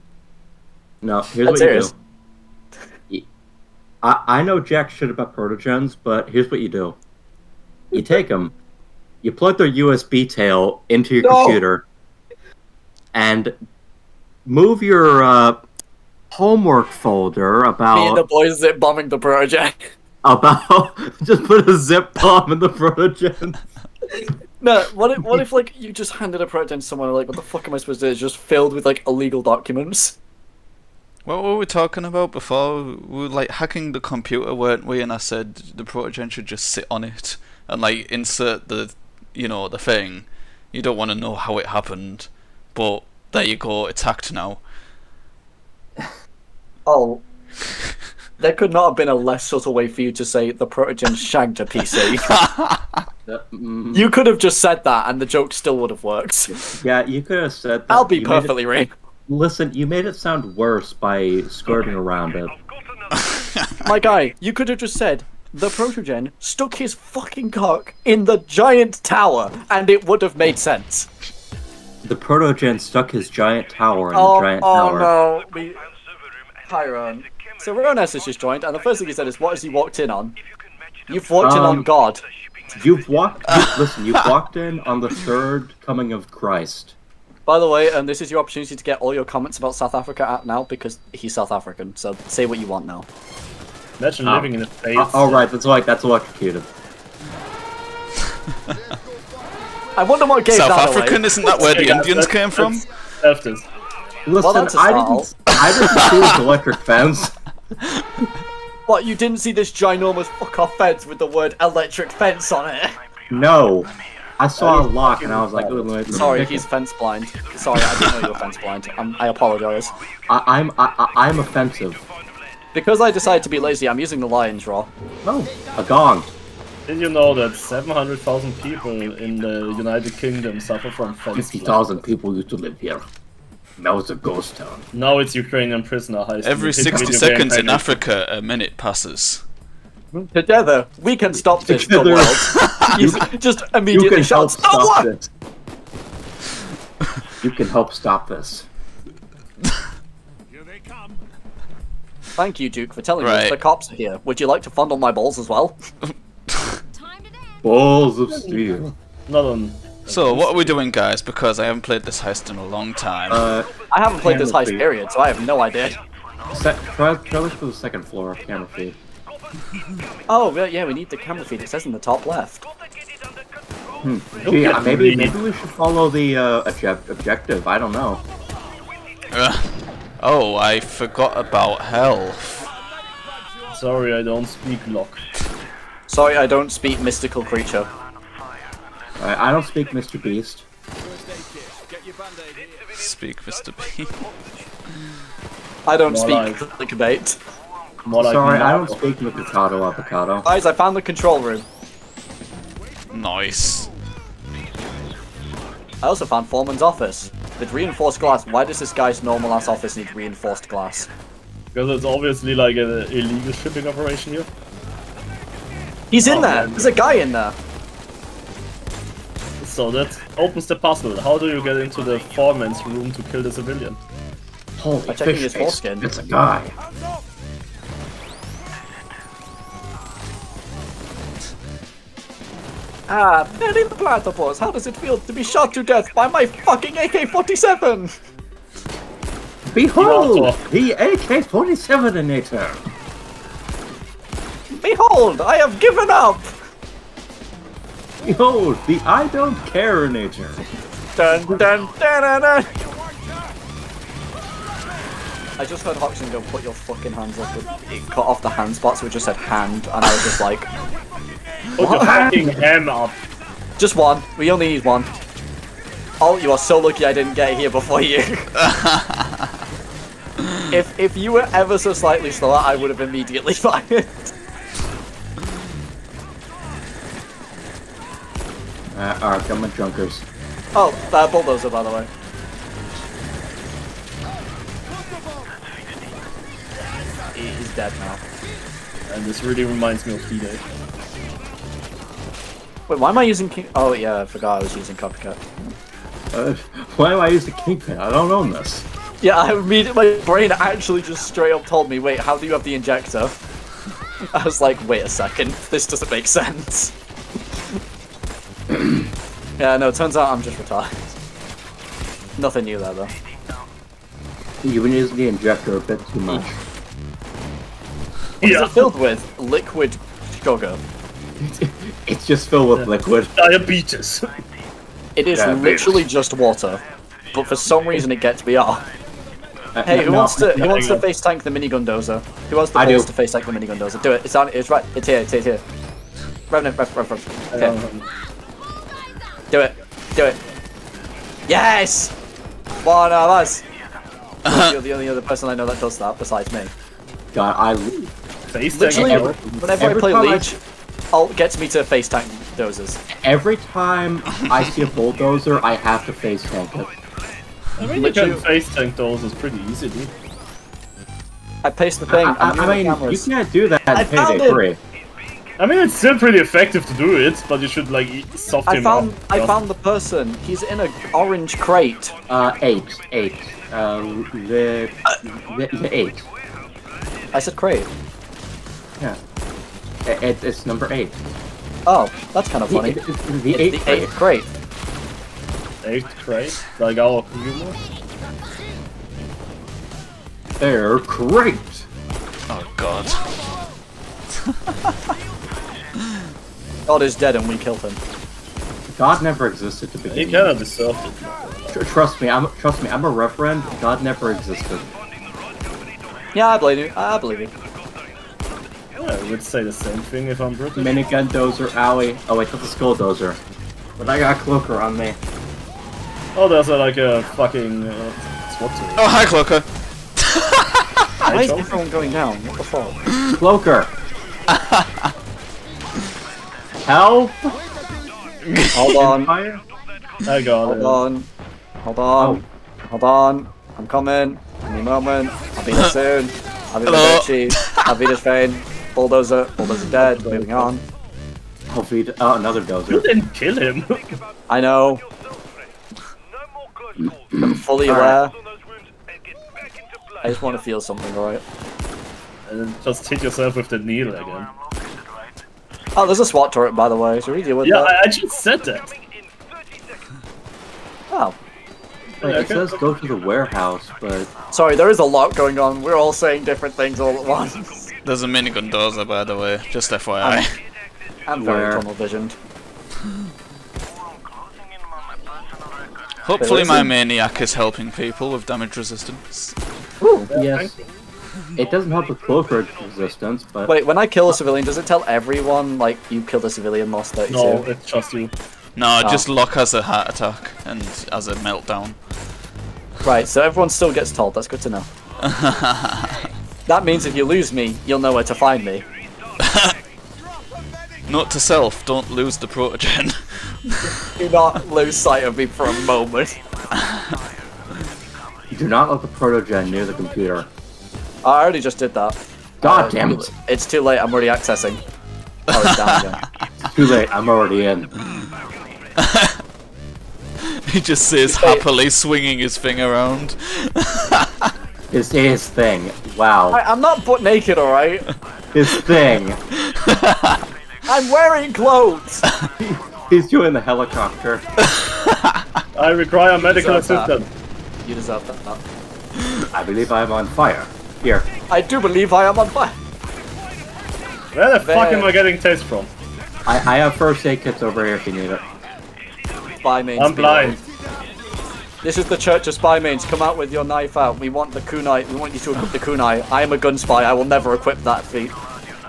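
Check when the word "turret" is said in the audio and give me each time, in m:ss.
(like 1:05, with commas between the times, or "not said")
7:36.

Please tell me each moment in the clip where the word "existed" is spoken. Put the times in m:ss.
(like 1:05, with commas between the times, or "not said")
6:39, 6:44.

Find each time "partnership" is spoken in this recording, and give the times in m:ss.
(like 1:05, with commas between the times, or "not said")
not said.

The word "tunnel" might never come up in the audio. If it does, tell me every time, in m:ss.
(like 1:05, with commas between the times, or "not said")
7:51.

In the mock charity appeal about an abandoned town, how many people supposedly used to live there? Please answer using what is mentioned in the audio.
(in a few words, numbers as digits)
50,000.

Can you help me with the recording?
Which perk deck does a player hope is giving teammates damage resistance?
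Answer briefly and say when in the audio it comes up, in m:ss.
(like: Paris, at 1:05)
Maniac, at 7:56.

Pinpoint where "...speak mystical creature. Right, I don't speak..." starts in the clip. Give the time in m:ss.
3:06.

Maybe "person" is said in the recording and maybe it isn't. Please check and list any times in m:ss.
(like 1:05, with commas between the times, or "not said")
5:45, 6:09.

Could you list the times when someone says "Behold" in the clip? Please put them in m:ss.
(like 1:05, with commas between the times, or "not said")
3:59, 4:04.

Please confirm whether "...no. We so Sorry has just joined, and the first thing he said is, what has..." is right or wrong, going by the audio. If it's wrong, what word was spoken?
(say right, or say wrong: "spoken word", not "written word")
wrong: "Ronas", not "Sorry".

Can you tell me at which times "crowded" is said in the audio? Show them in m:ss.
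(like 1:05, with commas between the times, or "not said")
not said.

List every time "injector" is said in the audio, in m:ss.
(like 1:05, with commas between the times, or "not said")
5:02, 5:15.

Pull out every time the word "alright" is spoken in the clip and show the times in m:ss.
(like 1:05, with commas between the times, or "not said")
4:39, 7:31, 8:47.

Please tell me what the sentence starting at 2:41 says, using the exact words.
Because I haven't played this heist in a long time.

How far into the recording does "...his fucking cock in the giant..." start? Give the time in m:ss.
1:06.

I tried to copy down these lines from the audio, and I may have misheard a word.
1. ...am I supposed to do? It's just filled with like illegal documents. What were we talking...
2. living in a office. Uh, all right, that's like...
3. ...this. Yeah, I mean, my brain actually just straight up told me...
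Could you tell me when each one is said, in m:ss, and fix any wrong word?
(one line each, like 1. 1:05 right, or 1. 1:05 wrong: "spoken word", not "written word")
1. 0:27 right
2. 1:34 wrong: "space", not "office"
3. 4:58 right.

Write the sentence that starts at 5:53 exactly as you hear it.
Every time I see a bulldozer, I have to face tank it.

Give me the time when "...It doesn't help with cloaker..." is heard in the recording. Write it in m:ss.
8:01.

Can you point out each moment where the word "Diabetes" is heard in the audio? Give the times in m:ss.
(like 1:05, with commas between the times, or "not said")
5:23.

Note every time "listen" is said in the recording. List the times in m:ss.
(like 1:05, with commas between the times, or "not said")
0:59, 1:23, 1:44.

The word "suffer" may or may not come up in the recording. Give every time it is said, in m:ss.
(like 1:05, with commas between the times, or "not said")
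2:10.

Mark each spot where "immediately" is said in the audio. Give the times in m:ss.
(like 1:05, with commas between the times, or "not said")
2:23, 4:32.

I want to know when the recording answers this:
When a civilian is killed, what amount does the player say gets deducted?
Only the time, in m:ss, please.
8:06.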